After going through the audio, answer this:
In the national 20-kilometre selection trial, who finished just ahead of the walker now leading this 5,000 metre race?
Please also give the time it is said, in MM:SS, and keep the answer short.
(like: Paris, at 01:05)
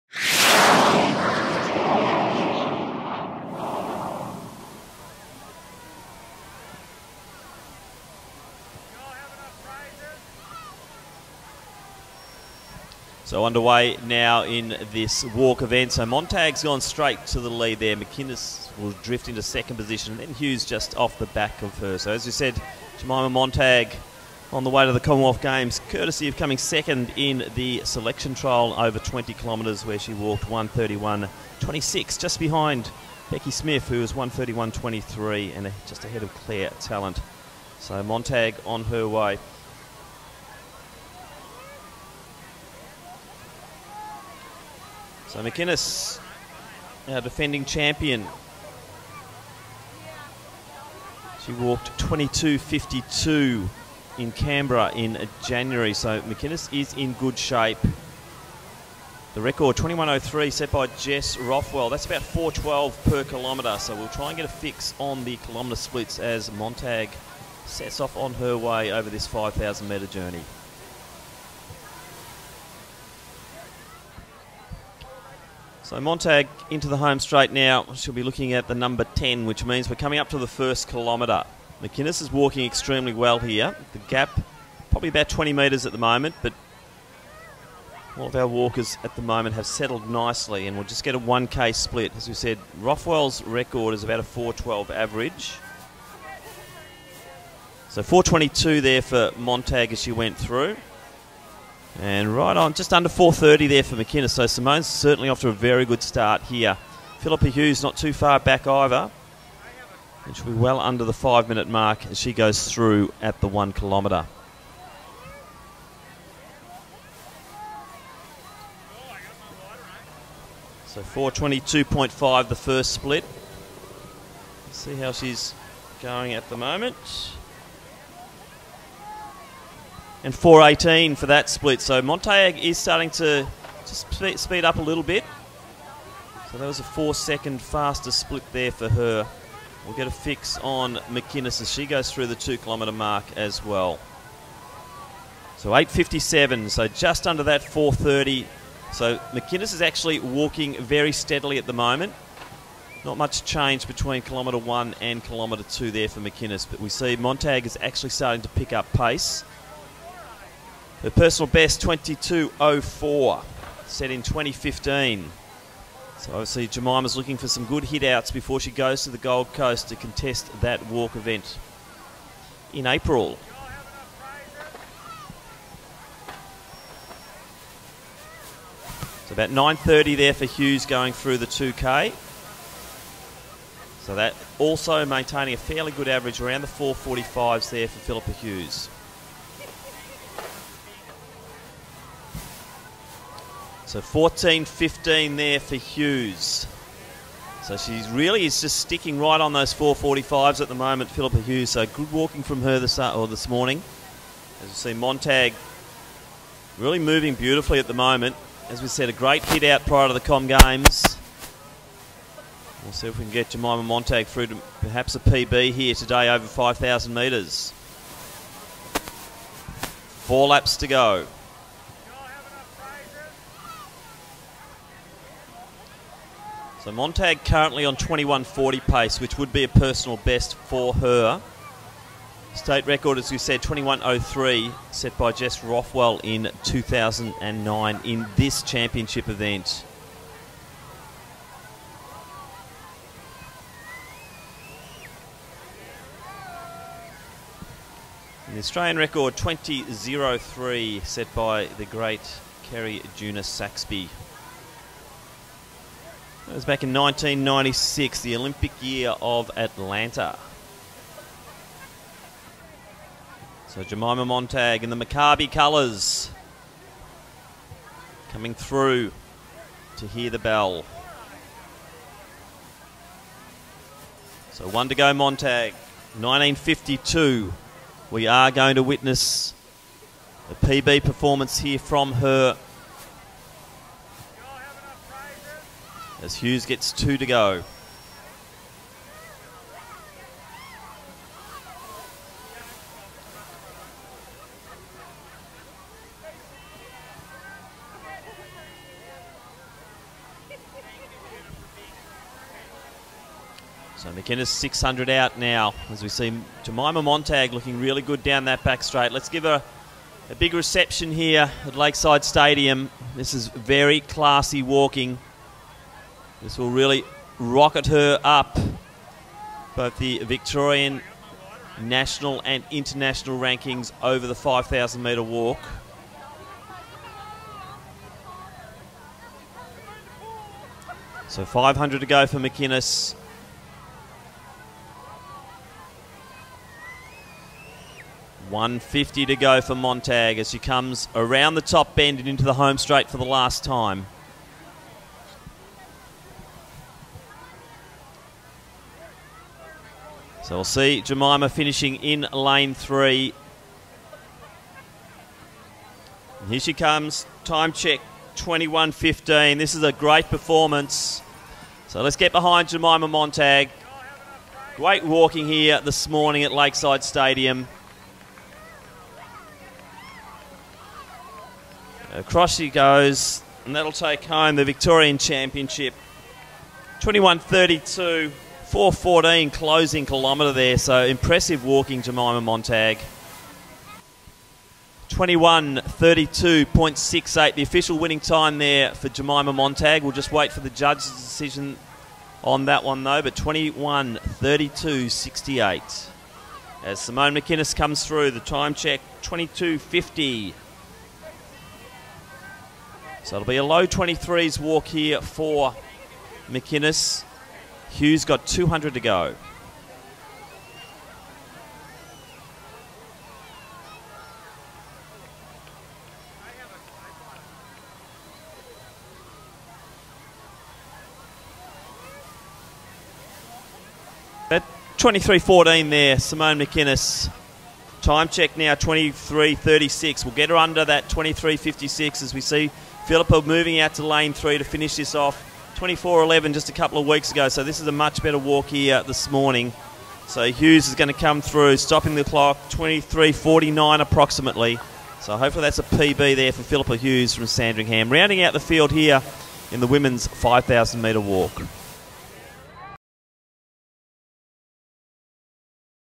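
Beki Smith, at 00:33.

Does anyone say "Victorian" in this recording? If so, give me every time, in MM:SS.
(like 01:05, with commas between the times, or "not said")
05:20, 06:14.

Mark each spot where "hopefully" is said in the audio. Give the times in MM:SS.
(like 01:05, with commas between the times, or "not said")
07:25.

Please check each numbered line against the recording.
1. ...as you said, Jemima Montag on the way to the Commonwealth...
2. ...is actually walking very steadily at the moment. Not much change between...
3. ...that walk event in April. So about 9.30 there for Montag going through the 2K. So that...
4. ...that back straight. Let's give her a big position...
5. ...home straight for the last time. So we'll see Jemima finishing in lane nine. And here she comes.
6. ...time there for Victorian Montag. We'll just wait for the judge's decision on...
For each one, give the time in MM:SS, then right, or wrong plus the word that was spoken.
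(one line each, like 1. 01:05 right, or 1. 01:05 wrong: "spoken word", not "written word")
1. 00:22 right
2. 02:29 right
3. 02:50 wrong: "Hughes", not "Montag"
4. 05:08 wrong: "reception", not "position"
5. 05:42 wrong: "three", not "nine"
6. 06:28 wrong: "Jemima", not "Victorian".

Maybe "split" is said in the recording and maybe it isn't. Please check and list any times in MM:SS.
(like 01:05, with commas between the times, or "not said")
01:05, 01:31, 02:02, 02:11, 02:18.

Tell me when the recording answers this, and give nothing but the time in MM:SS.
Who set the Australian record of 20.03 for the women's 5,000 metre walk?
04:12.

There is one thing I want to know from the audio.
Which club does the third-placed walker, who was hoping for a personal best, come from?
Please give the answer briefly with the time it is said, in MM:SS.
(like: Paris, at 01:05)
Sandringham, at 07:27.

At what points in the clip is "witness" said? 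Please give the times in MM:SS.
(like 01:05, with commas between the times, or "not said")
04:38.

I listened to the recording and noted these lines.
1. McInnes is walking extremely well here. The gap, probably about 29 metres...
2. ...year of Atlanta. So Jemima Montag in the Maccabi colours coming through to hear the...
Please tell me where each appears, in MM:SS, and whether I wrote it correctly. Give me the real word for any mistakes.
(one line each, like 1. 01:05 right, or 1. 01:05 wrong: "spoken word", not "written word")
1. 01:21 wrong: "20", not "29"
2. 04:18 right.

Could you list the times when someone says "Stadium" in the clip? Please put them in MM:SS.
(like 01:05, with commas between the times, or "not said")
05:12, 06:07.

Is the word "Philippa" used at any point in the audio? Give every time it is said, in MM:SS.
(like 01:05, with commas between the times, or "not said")
01:47, 03:07, 03:21, 07:13, 07:26.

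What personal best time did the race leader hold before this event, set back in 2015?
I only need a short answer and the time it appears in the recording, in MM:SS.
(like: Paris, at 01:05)
22.04, at 02:41.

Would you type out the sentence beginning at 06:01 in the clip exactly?
So let's get behind Jemima Montag.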